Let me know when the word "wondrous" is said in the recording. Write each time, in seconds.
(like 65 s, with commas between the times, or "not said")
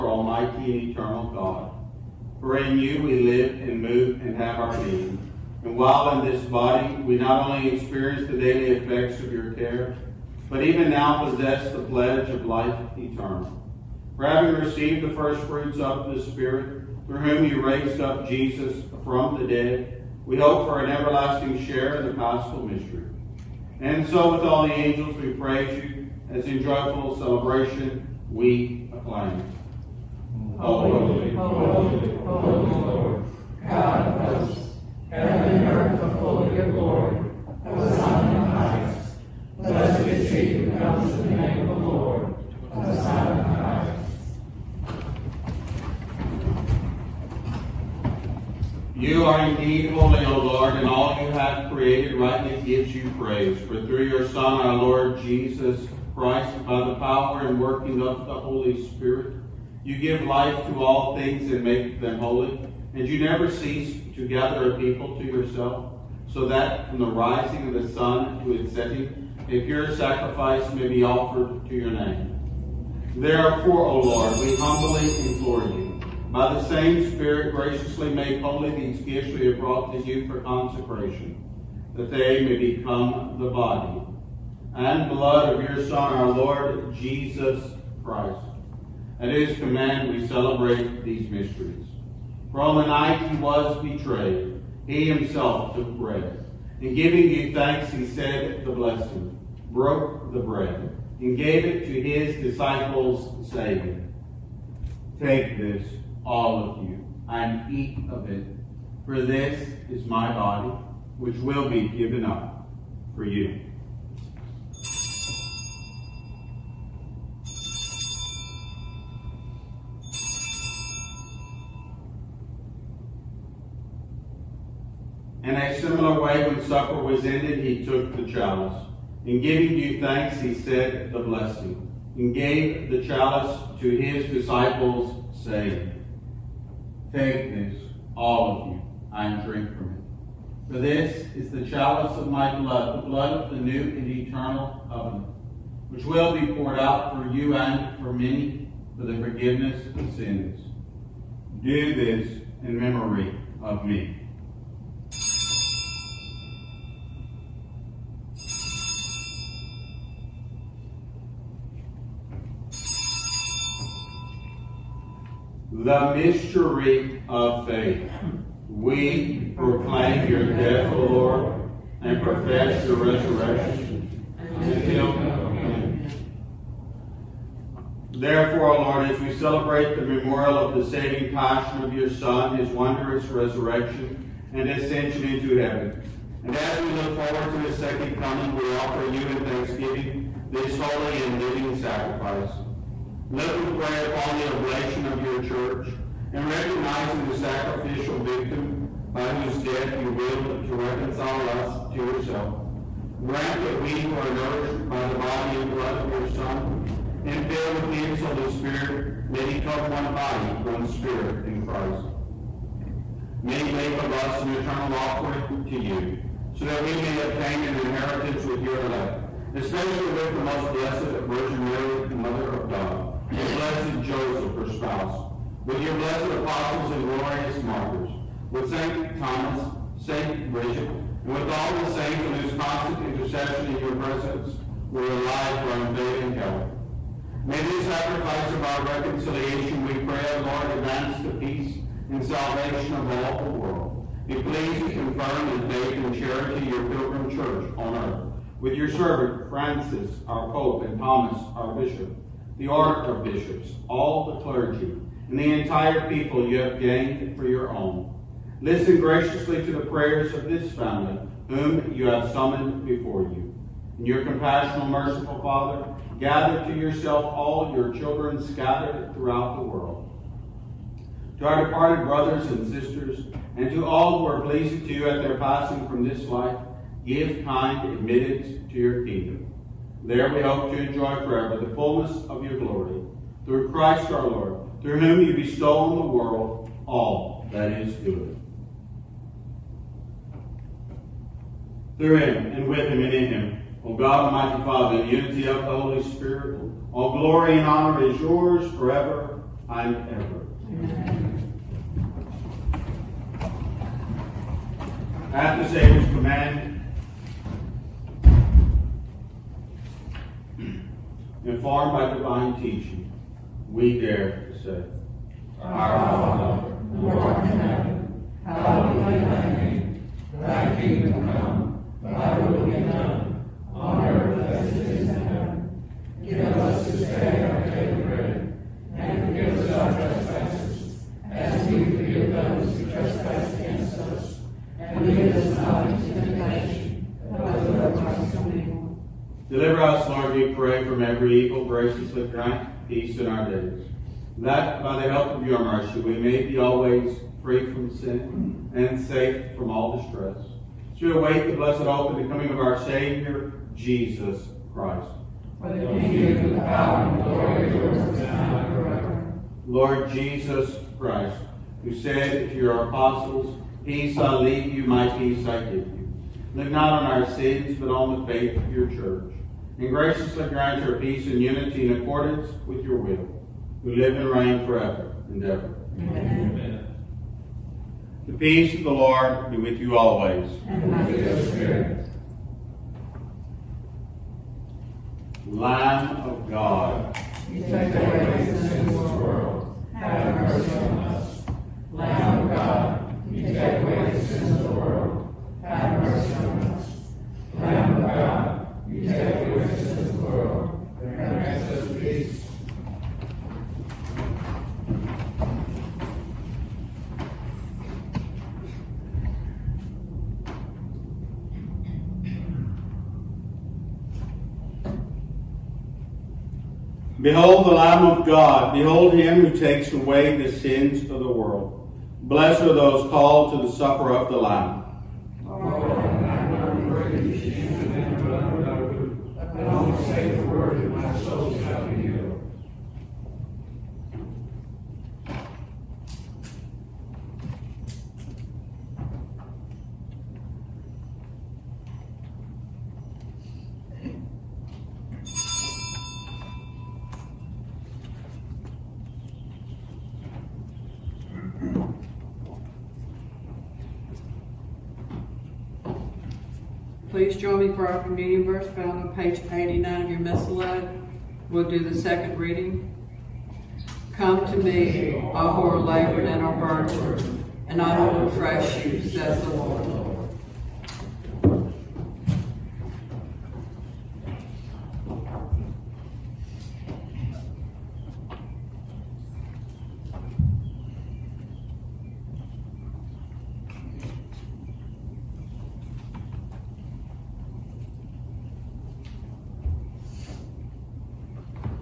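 182 s.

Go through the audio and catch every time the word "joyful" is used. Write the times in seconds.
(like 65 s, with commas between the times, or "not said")
26 s.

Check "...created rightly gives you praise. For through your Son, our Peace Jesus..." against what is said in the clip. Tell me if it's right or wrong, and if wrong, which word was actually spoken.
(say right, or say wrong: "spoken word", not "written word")
wrong: "Lord", not "Peace".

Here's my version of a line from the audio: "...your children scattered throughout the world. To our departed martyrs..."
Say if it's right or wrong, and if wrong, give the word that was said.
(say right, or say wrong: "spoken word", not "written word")
wrong: "brothers", not "martyrs".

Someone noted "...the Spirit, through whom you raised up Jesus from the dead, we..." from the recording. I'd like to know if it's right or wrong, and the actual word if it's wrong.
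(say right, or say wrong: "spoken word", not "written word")
right.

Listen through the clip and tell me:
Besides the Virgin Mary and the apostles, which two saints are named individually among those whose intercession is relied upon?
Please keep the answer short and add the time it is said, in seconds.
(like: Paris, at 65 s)
St. Thomas, St. Bridget, at 228 s.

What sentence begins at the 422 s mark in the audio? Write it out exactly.
Blessed are those called to the supper of the Lamb.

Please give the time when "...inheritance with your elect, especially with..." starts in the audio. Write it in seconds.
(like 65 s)
217 s.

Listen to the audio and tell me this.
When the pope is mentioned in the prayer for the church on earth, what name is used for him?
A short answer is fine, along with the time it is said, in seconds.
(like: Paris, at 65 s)
Francis, at 249 s.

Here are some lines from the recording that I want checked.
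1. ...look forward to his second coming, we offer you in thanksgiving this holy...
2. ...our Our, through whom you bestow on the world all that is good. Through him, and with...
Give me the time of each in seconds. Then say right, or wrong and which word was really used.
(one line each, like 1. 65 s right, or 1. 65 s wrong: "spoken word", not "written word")
1. 186 s right
2. 284 s wrong: "Lord", not "Our".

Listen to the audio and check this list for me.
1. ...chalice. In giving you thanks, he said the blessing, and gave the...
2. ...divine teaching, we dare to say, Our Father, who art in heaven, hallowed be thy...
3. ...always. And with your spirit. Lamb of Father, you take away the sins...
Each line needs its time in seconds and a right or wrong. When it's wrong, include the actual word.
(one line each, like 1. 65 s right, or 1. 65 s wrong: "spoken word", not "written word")
1. 128 s right
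2. 312 s right
3. 379 s wrong: "God", not "Father".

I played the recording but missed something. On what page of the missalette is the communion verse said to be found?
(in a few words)
89.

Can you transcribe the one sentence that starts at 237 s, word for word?
May this sacrifice of our reconciliation, we pray, O Lord, advance the peace and salvation of all the world.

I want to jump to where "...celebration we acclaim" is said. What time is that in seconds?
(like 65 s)
27 s.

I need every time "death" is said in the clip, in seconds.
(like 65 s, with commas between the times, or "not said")
170 s, 199 s.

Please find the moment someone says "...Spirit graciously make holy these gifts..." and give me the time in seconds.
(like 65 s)
77 s.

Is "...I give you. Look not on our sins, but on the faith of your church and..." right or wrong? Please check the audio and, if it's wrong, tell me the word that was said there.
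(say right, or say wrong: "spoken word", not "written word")
right.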